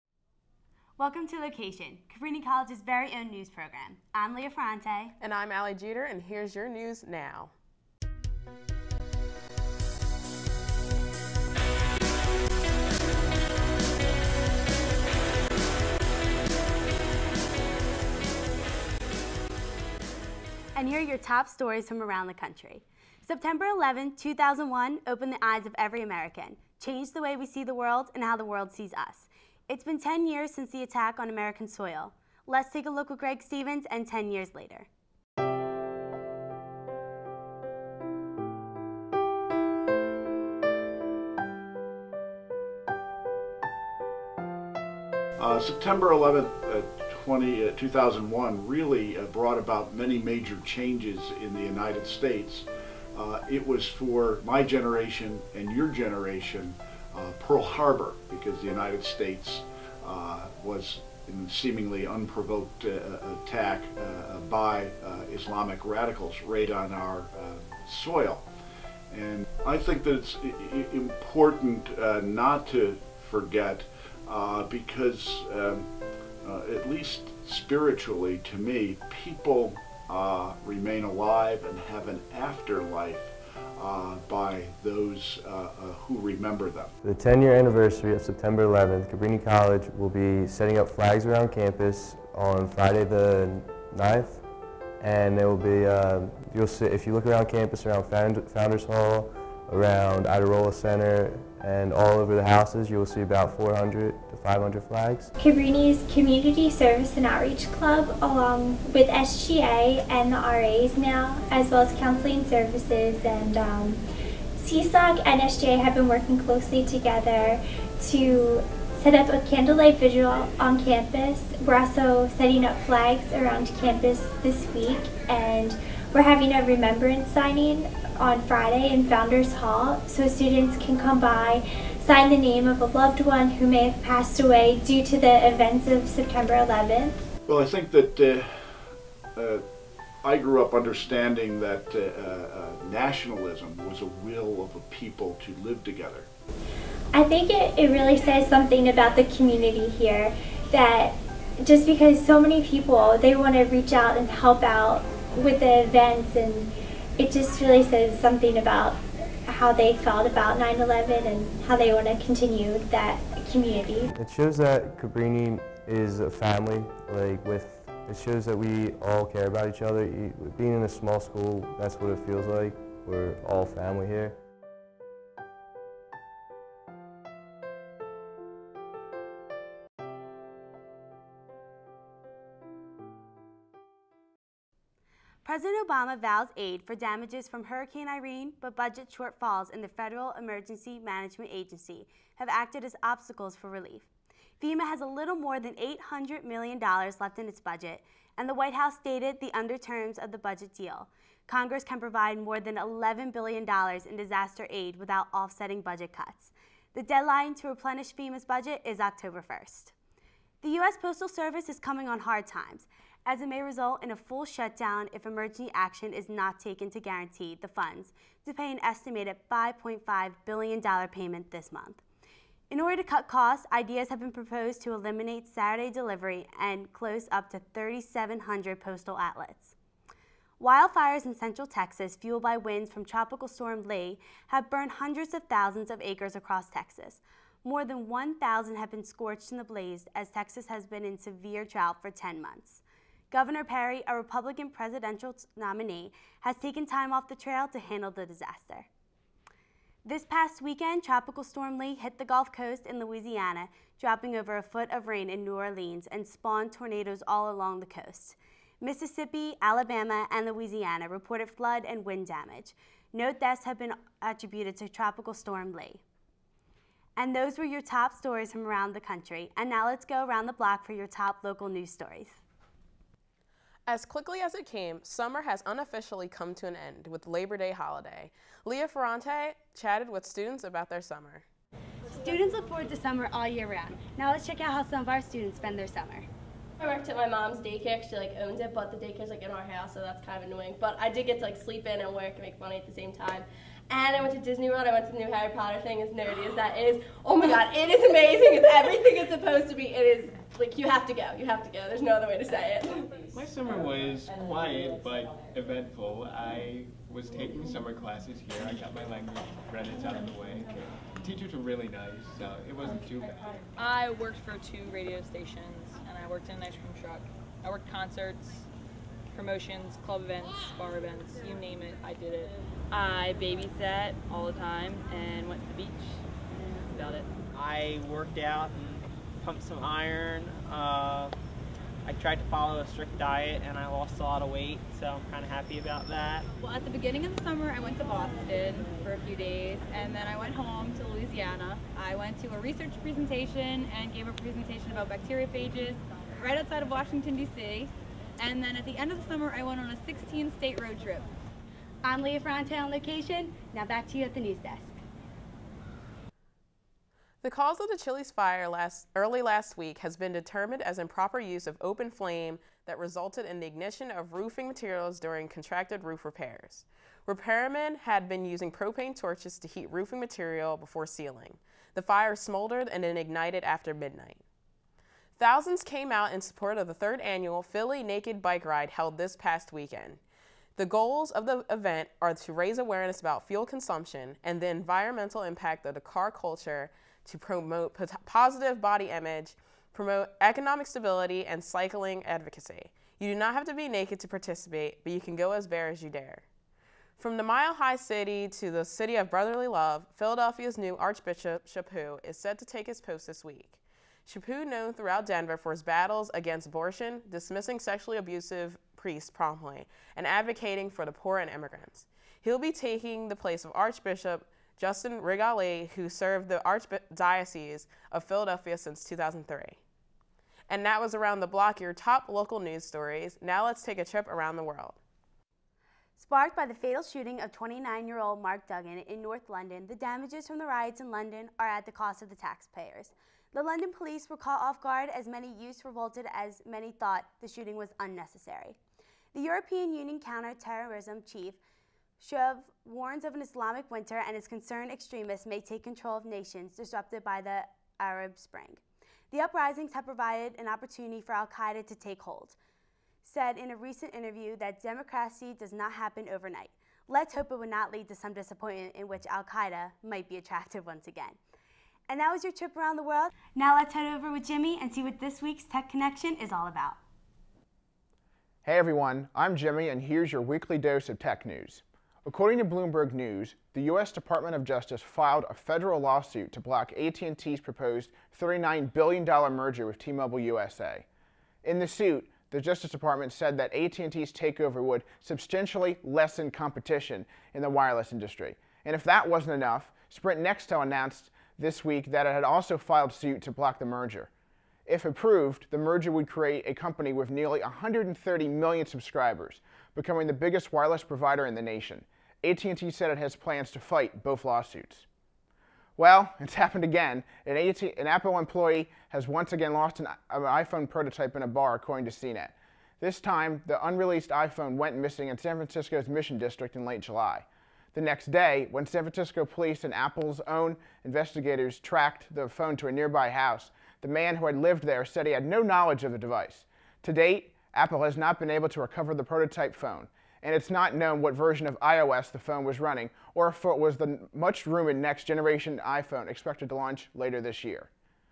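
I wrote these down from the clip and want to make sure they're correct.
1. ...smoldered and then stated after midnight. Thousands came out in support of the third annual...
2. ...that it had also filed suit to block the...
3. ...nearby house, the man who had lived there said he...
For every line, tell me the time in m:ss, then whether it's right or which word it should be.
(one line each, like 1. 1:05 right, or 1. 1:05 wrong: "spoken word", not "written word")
1. 6:12 wrong: "ignited", not "stated"
2. 8:12 right
3. 8:42 right.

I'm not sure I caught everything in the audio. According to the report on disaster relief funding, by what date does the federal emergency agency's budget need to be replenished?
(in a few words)
October 1st.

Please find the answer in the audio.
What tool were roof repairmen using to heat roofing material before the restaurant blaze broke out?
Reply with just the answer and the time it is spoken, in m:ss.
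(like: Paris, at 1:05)
propane torches, at 6:08.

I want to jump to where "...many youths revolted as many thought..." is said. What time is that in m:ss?
7:15.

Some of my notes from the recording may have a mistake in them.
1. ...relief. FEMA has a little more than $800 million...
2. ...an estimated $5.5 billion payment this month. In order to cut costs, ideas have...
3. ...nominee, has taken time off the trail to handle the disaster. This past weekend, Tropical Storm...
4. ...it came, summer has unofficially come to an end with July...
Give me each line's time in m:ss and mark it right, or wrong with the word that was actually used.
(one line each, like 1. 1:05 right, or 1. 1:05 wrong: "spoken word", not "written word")
1. 3:13 right
2. 3:38 right
3. 4:05 right
4. 4:34 wrong: "Labor", not "July".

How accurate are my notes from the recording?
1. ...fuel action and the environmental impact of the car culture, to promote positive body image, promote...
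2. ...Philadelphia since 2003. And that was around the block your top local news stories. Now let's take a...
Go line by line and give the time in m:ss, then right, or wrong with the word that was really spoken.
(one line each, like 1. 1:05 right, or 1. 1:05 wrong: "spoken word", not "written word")
1. 6:23 wrong: "consumption", not "action"
2. 6:58 right.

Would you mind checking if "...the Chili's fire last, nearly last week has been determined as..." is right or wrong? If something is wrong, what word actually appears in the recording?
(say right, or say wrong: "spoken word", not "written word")
wrong: "early", not "nearly".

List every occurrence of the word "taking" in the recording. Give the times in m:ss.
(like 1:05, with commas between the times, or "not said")
5:07, 6:52.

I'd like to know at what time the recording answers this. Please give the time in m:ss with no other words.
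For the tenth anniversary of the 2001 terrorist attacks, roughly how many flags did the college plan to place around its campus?
1:43.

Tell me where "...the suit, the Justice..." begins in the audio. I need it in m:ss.
8:01.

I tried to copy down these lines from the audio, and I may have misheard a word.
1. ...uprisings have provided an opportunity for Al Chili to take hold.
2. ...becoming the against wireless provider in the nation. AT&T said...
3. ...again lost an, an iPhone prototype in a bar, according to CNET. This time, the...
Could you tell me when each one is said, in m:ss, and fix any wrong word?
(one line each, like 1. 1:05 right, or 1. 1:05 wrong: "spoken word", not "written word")
1. 7:29 wrong: "Qaeda", not "Chili"
2. 8:19 wrong: "biggest", not "against"
3. 8:29 right.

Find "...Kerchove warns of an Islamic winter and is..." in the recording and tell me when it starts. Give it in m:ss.
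7:22.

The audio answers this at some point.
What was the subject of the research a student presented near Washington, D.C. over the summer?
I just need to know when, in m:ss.
5:45.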